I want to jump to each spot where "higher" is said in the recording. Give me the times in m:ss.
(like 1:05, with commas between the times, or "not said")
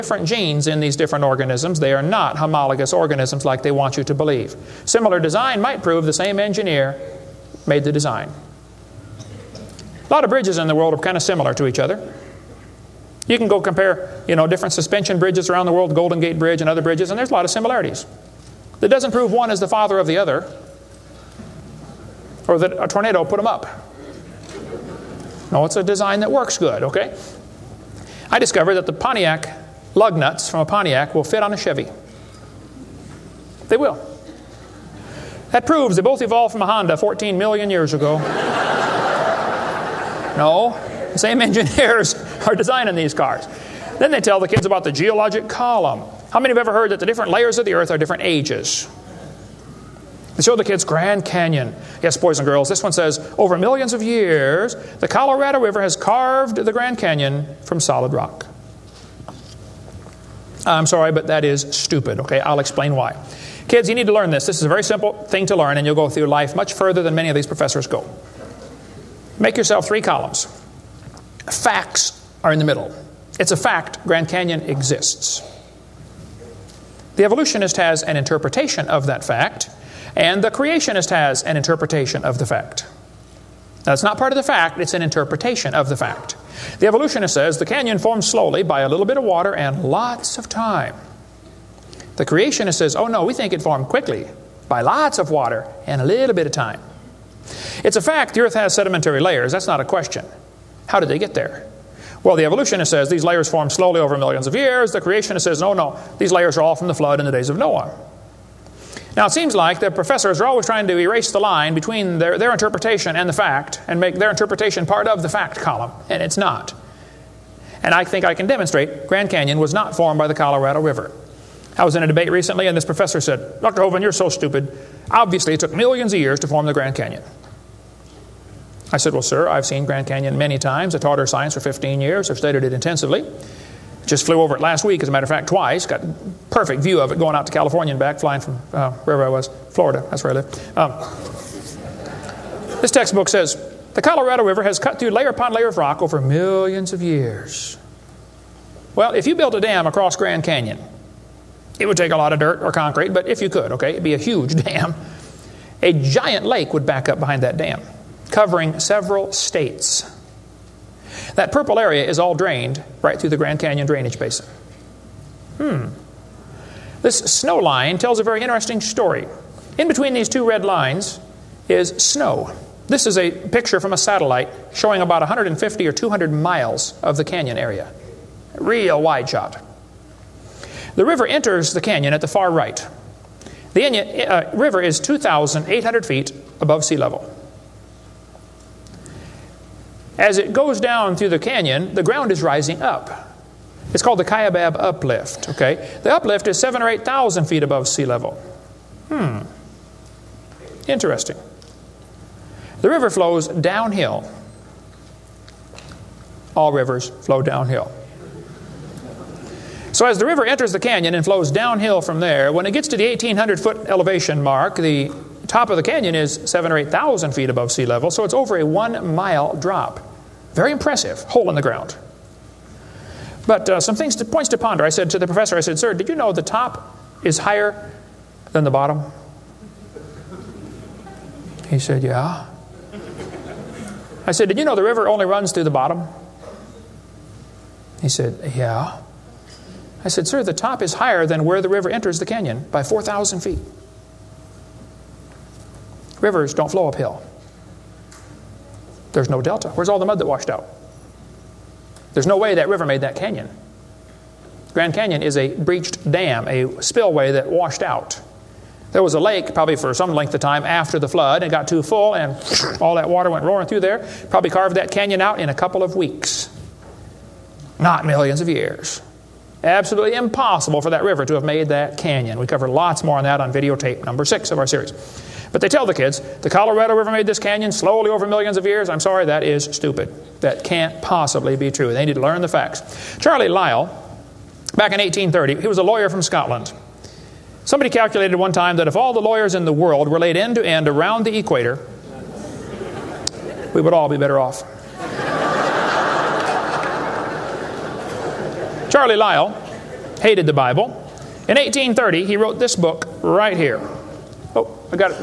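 3:47, 4:00.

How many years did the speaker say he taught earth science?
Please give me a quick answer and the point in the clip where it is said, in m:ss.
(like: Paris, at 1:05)
15, at 2:11.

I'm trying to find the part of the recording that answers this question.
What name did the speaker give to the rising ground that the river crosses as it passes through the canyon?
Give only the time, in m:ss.
3:14.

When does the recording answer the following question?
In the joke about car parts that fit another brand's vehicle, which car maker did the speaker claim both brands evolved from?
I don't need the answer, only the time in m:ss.
0:36.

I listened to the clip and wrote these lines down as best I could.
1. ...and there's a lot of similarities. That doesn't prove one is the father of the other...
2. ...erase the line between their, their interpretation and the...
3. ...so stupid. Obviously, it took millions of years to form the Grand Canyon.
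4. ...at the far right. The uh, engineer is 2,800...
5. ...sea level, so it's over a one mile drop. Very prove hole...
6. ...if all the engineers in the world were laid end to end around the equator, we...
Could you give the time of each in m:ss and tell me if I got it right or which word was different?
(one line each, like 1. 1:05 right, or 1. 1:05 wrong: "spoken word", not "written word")
1. 0:17 right
2. 1:50 right
3. 2:04 right
4. 3:02 wrong: "river", not "engineer"
5. 3:37 wrong: "impressive", not "prove"
6. 4:48 wrong: "lawyers", not "engineers".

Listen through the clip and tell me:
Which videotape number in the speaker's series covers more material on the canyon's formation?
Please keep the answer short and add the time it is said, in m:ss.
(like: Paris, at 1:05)
6, at 4:33.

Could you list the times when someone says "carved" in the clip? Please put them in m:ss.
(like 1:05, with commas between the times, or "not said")
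0:55, 4:24.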